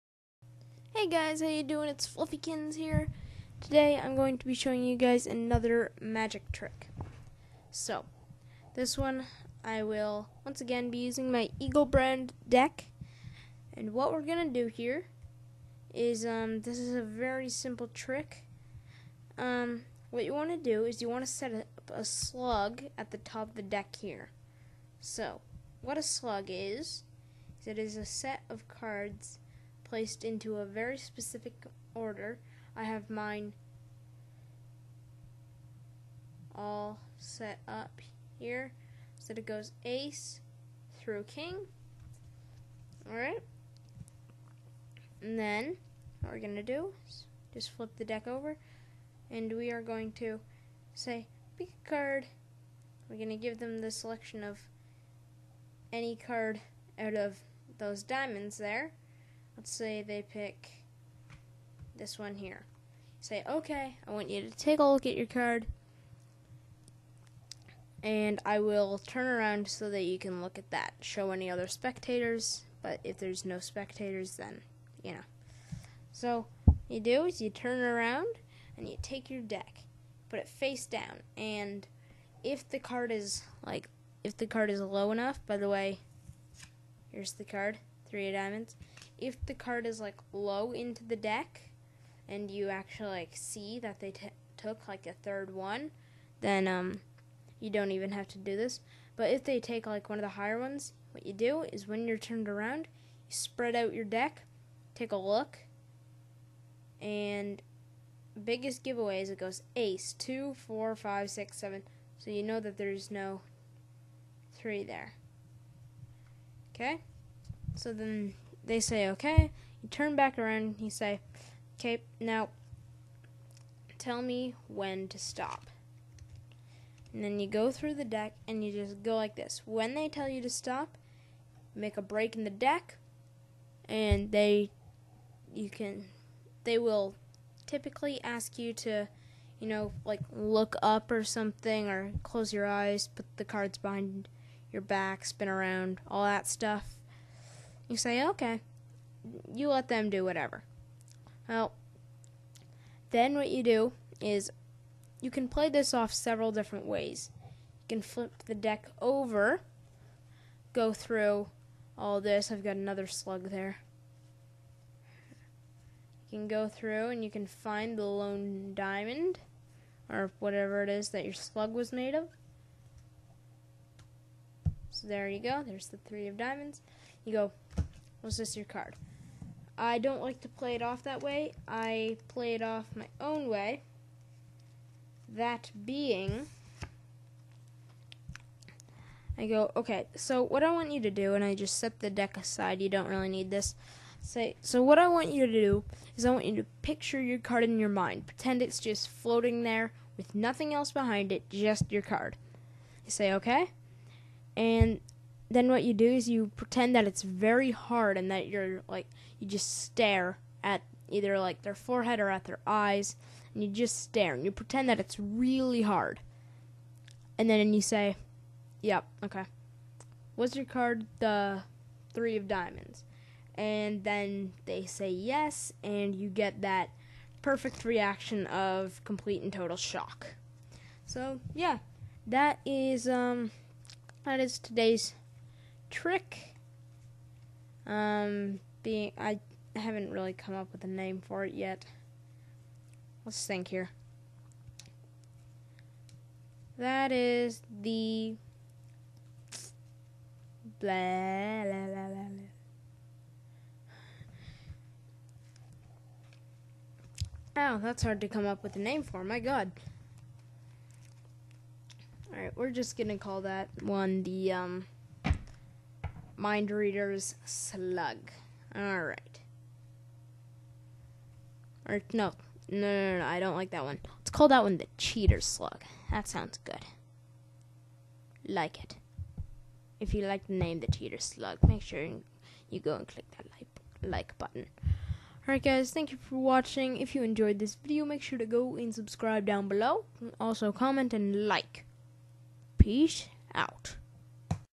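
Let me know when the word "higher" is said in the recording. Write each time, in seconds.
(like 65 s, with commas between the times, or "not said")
100 s.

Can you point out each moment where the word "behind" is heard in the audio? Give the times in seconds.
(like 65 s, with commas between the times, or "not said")
143 s, 200 s.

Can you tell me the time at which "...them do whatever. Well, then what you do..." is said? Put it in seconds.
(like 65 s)
149 s.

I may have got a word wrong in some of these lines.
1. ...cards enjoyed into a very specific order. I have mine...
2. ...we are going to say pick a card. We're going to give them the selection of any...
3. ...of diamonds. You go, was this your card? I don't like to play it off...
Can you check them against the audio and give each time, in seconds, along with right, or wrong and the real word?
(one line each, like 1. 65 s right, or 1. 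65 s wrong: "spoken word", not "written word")
1. 28 s wrong: "placed", not "enjoyed"
2. 49 s right
3. 176 s right.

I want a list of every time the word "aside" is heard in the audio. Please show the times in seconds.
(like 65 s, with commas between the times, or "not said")
192 s.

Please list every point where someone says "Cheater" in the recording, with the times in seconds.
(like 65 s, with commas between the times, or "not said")
274 s, 280 s.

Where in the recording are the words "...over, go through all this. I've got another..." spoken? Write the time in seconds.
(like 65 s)
159 s.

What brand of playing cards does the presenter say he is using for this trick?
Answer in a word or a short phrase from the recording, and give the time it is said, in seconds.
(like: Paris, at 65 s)
Eagle, at 11 s.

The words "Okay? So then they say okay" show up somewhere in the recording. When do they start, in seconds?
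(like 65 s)
116 s.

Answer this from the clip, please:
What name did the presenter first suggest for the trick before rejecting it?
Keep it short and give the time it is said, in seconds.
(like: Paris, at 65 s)
Mind Reader's Slug, at 266 s.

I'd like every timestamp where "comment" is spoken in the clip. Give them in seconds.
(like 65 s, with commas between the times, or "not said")
290 s.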